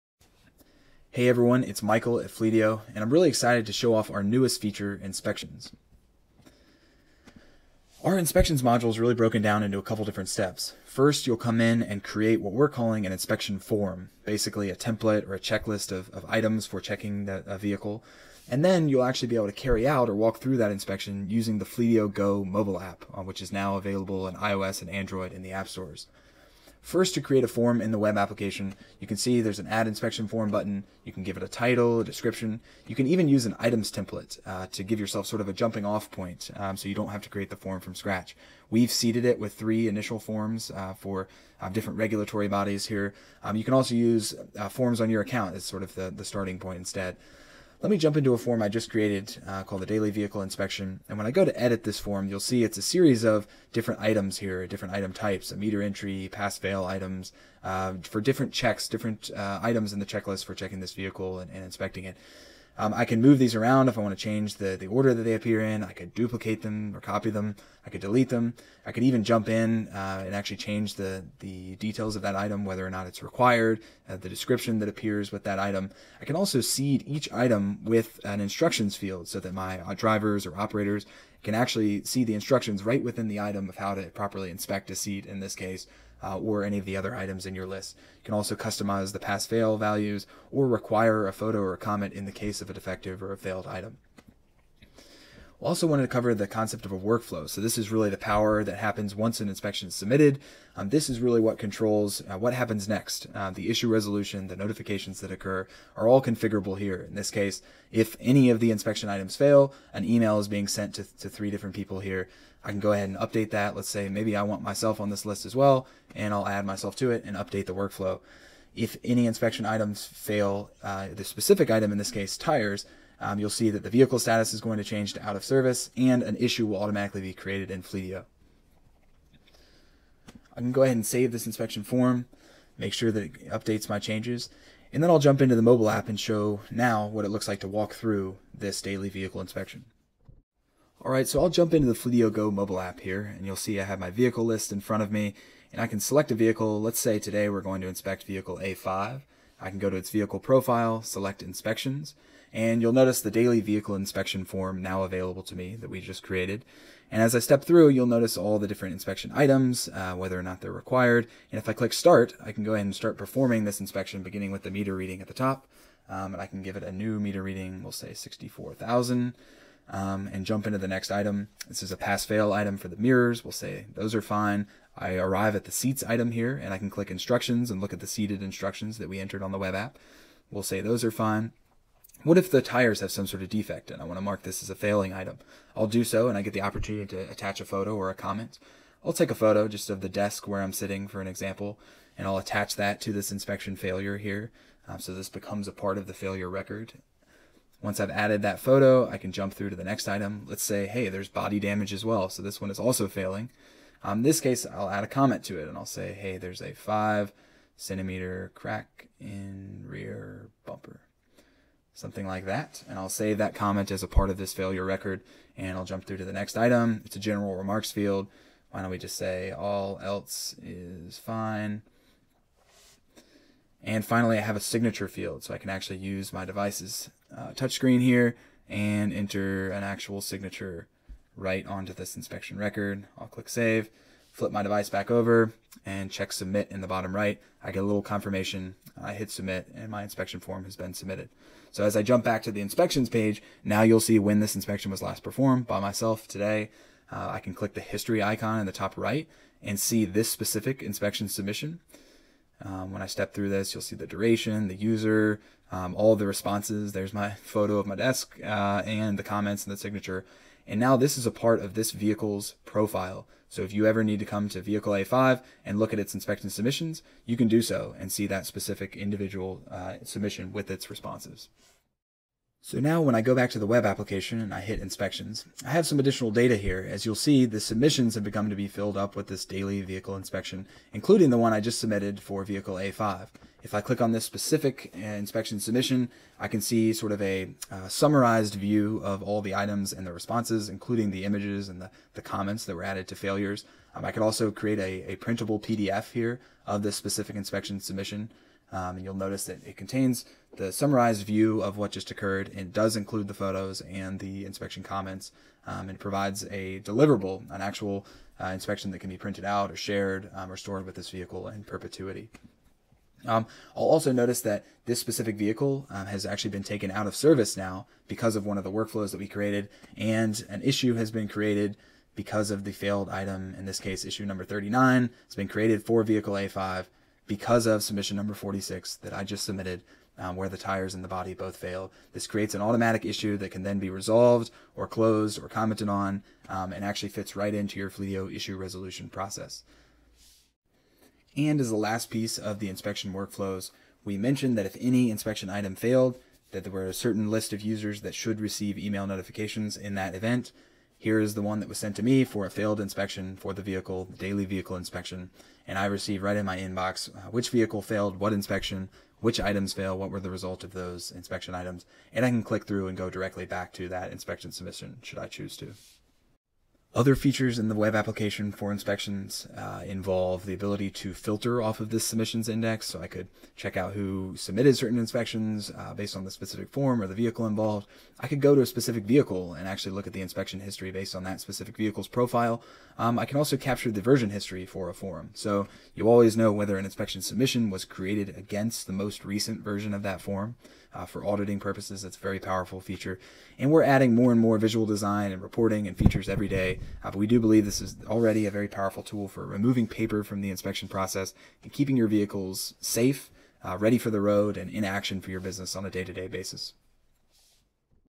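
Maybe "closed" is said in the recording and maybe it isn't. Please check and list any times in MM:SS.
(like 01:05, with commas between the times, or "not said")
05:34.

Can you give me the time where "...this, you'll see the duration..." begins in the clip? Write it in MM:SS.
04:13.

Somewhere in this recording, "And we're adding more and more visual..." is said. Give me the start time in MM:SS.
06:33.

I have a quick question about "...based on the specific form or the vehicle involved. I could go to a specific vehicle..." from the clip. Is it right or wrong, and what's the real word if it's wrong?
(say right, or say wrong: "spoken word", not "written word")
right.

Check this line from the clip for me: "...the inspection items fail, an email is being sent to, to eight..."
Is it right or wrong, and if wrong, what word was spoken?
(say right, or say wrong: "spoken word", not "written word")
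wrong: "three", not "eight".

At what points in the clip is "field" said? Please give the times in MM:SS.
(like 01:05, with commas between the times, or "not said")
01:18, 03:37, 03:45.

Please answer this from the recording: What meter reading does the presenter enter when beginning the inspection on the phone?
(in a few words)
64,000.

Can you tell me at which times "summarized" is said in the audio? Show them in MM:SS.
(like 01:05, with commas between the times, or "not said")
04:47, 05:00.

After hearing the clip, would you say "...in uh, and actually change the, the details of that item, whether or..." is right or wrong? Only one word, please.
right.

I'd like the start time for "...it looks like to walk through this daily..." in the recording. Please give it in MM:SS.
02:17.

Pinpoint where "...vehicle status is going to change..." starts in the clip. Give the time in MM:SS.
02:03.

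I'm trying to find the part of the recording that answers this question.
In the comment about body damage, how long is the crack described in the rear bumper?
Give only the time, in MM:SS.
03:26.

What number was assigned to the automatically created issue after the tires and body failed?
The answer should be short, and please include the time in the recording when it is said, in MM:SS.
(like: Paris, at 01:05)
39, at 05:24.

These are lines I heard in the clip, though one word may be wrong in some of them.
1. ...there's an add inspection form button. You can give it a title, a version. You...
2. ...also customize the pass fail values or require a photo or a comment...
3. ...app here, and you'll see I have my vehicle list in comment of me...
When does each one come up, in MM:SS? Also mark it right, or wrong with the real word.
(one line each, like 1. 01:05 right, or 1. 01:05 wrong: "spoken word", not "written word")
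1. 00:29 wrong: "description", not "version"
2. 01:28 right
3. 02:22 wrong: "front", not "comment".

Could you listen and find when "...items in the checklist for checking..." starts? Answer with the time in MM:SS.
00:59.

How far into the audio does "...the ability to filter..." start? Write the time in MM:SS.
06:10.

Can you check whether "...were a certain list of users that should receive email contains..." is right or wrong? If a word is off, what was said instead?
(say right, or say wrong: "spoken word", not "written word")
wrong: "notifications", not "contains".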